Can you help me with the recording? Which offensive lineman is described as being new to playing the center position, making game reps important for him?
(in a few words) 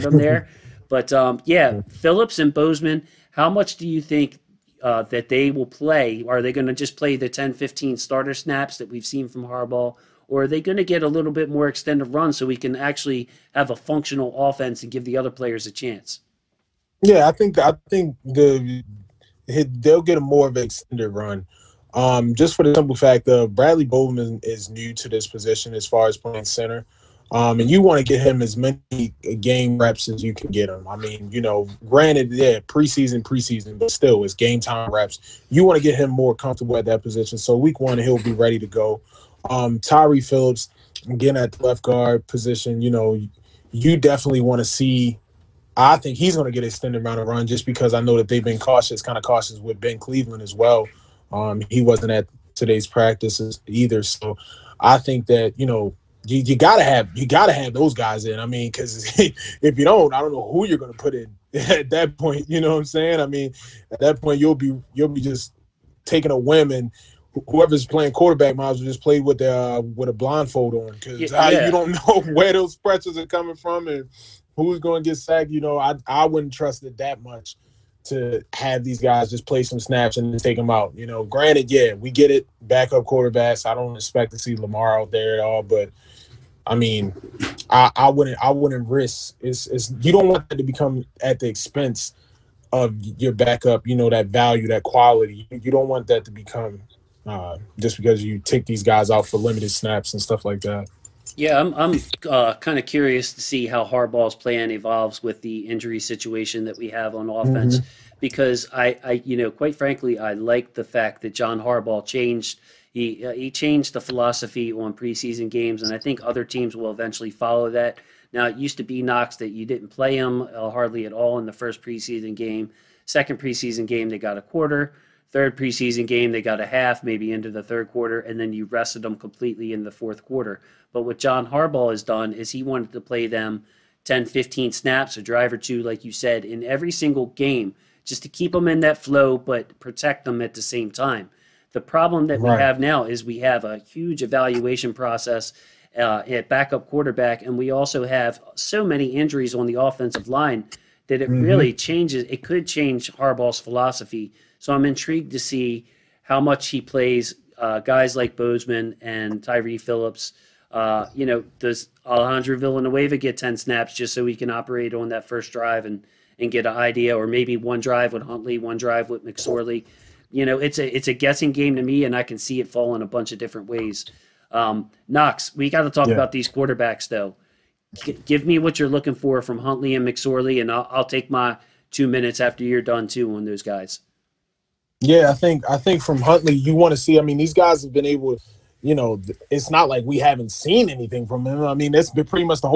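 Bradley Bozeman.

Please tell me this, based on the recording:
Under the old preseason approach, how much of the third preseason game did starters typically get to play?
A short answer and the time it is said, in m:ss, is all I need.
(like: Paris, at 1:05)
a half, at 2:06.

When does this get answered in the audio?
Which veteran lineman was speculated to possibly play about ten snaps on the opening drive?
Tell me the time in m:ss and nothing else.
2:42.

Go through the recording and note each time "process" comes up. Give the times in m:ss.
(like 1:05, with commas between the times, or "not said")
2:24.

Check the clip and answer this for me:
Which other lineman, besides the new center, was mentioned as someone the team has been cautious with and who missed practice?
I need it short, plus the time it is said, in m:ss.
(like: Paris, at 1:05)
Ben Cleveland, at 0:49.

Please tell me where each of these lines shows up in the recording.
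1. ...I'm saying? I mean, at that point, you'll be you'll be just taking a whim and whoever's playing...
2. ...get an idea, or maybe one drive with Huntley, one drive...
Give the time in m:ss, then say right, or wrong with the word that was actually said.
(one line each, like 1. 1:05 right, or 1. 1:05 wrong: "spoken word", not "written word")
1. 1:02 right
2. 2:46 right.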